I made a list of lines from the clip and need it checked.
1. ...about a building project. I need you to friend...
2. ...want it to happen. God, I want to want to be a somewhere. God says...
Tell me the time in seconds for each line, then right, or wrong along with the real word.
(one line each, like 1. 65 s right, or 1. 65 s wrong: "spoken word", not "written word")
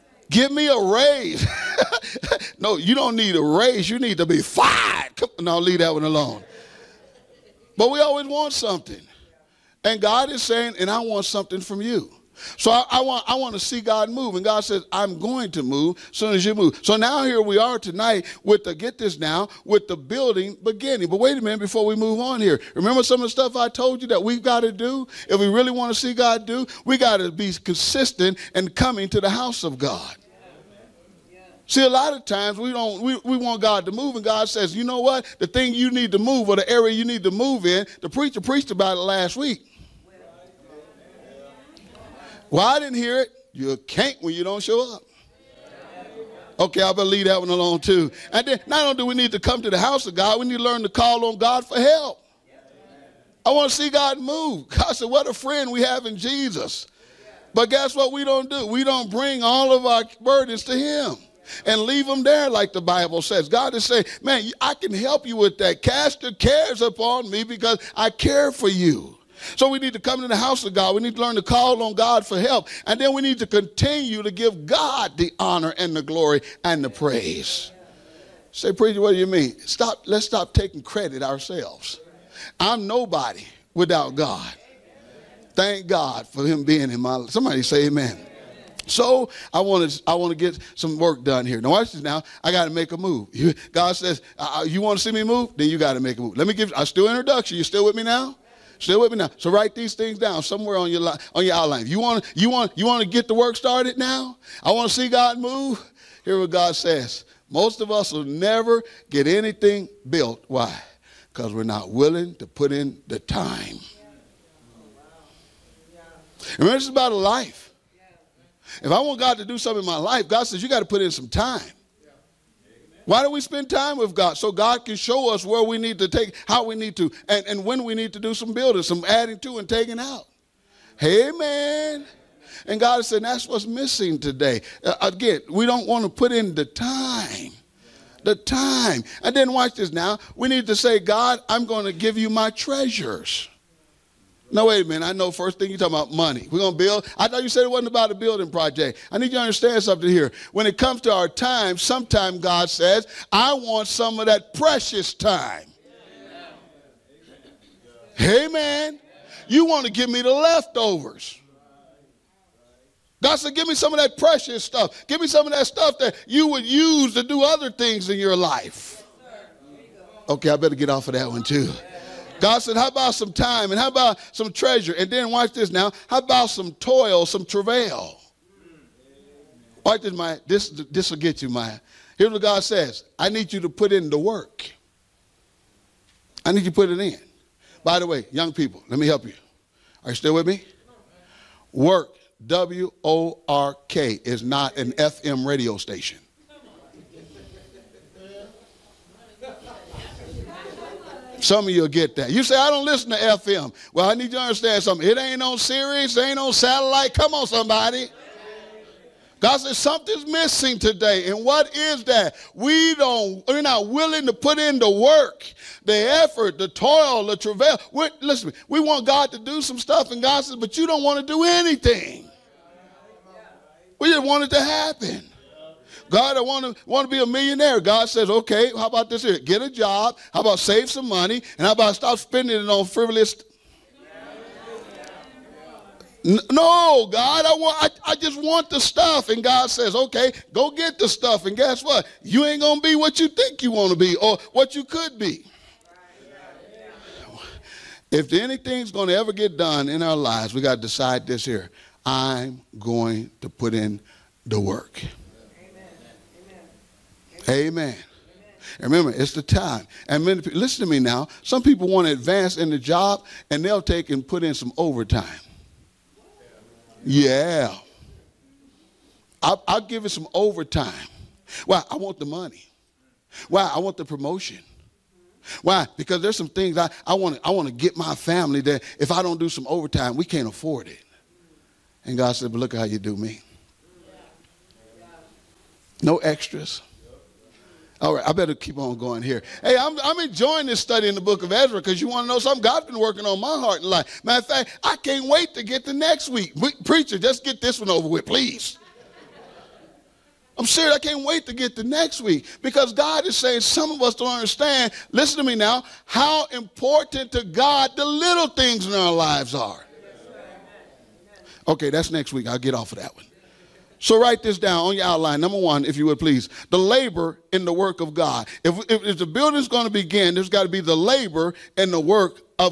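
1. 147 s wrong: "understand", not "friend"
2. 224 s wrong: "millionaire", not "somewhere".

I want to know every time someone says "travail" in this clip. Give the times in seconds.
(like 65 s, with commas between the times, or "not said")
177 s, 217 s.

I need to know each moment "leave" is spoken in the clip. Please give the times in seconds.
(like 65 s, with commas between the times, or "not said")
5 s, 47 s, 61 s.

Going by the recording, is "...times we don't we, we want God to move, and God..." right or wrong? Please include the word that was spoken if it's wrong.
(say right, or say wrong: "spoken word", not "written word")
right.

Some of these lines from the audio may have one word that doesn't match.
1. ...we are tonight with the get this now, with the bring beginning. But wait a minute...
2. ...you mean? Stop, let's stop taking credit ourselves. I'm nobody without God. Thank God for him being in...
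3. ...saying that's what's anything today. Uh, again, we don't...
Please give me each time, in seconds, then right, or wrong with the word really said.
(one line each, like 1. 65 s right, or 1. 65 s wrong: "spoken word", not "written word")
1. 17 s wrong: "building", not "bring"
2. 79 s right
3. 133 s wrong: "missing", not "anything".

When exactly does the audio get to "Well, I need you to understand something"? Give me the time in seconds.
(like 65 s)
203 s.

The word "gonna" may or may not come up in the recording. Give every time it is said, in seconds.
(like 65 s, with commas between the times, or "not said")
242 s, 248 s.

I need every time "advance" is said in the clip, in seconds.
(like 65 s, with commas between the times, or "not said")
262 s.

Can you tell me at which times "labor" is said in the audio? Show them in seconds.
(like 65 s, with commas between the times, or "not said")
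316 s, 320 s.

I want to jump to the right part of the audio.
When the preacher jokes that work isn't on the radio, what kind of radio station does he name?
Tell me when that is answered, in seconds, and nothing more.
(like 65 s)
194 s.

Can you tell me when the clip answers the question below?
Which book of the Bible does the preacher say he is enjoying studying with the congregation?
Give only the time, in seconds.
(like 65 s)
291 s.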